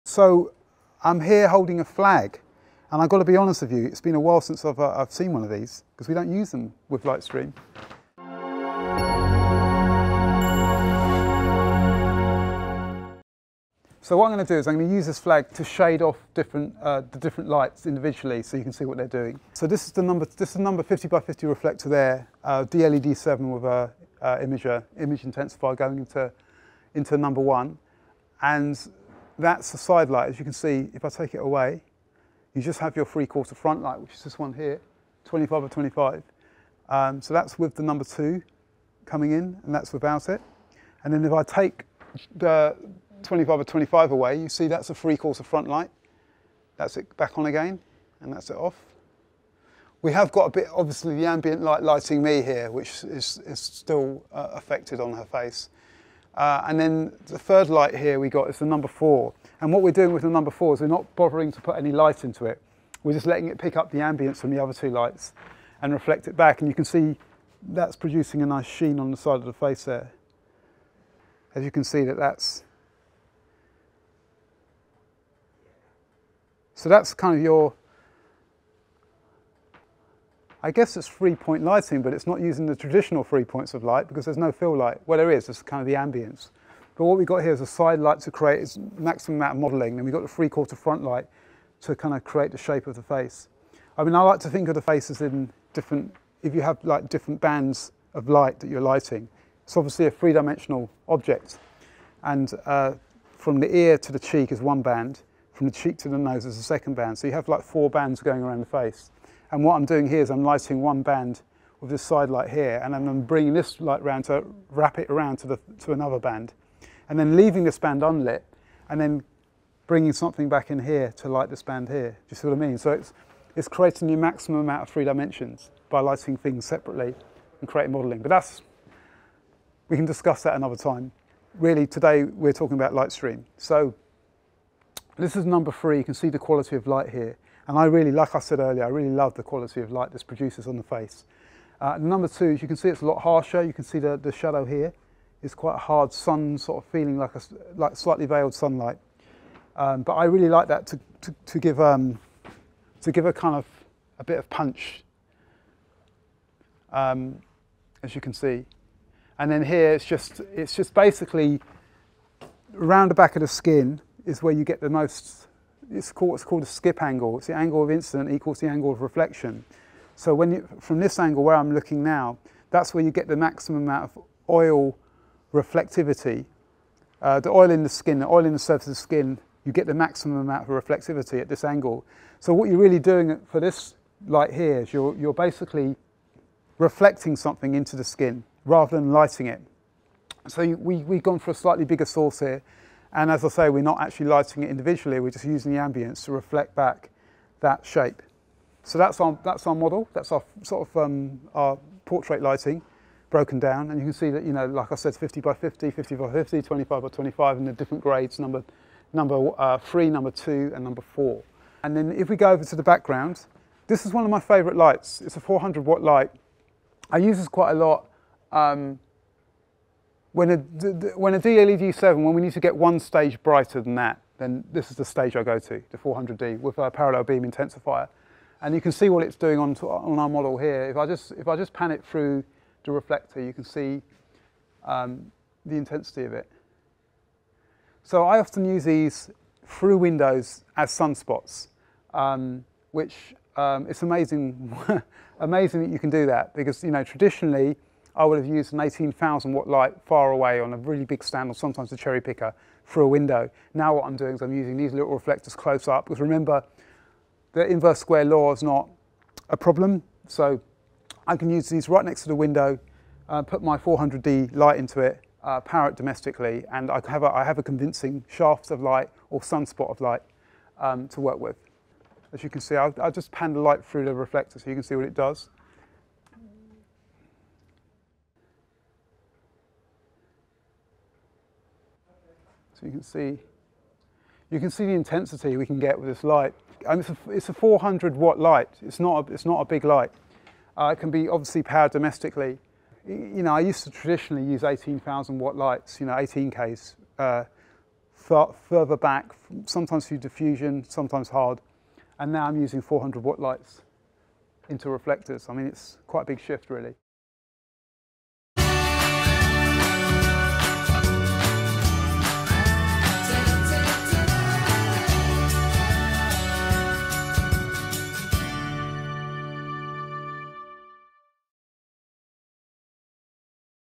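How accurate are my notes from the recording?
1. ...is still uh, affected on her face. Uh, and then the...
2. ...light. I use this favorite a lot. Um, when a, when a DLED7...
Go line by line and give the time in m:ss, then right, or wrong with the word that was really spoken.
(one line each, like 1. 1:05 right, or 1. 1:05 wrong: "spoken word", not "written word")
1. 0:53 right
2. 3:36 wrong: "quite", not "favorite".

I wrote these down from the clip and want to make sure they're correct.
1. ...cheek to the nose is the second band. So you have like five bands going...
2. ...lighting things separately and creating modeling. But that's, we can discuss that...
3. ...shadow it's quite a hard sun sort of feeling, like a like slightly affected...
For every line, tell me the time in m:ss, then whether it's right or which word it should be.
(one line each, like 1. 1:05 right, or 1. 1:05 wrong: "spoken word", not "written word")
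1. 1:45 wrong: "four", not "five"
2. 2:05 right
3. 2:24 wrong: "veiled", not "affected".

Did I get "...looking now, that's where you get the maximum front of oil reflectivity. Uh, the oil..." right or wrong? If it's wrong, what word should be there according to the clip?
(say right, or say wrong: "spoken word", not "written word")
wrong: "amount", not "front".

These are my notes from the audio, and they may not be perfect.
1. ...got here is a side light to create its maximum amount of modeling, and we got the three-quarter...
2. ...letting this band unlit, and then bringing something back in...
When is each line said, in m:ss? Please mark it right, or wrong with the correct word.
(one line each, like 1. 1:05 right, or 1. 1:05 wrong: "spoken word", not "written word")
1. 1:27 right
2. 1:57 wrong: "leaving", not "letting".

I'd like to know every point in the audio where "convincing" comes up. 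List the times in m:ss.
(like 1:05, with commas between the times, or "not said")
4:27.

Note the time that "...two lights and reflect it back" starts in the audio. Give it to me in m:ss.
1:04.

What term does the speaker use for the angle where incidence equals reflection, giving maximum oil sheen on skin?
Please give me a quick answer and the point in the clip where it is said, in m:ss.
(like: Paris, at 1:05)
skip angle, at 2:46.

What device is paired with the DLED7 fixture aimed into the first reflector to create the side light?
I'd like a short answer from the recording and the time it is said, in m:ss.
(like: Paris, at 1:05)
image intensifier, at 0:25.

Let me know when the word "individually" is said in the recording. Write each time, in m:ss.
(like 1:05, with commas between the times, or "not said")
0:17, 3:14.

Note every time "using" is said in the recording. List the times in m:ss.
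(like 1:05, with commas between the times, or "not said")
1:22, 3:15, 4:14, 5:02.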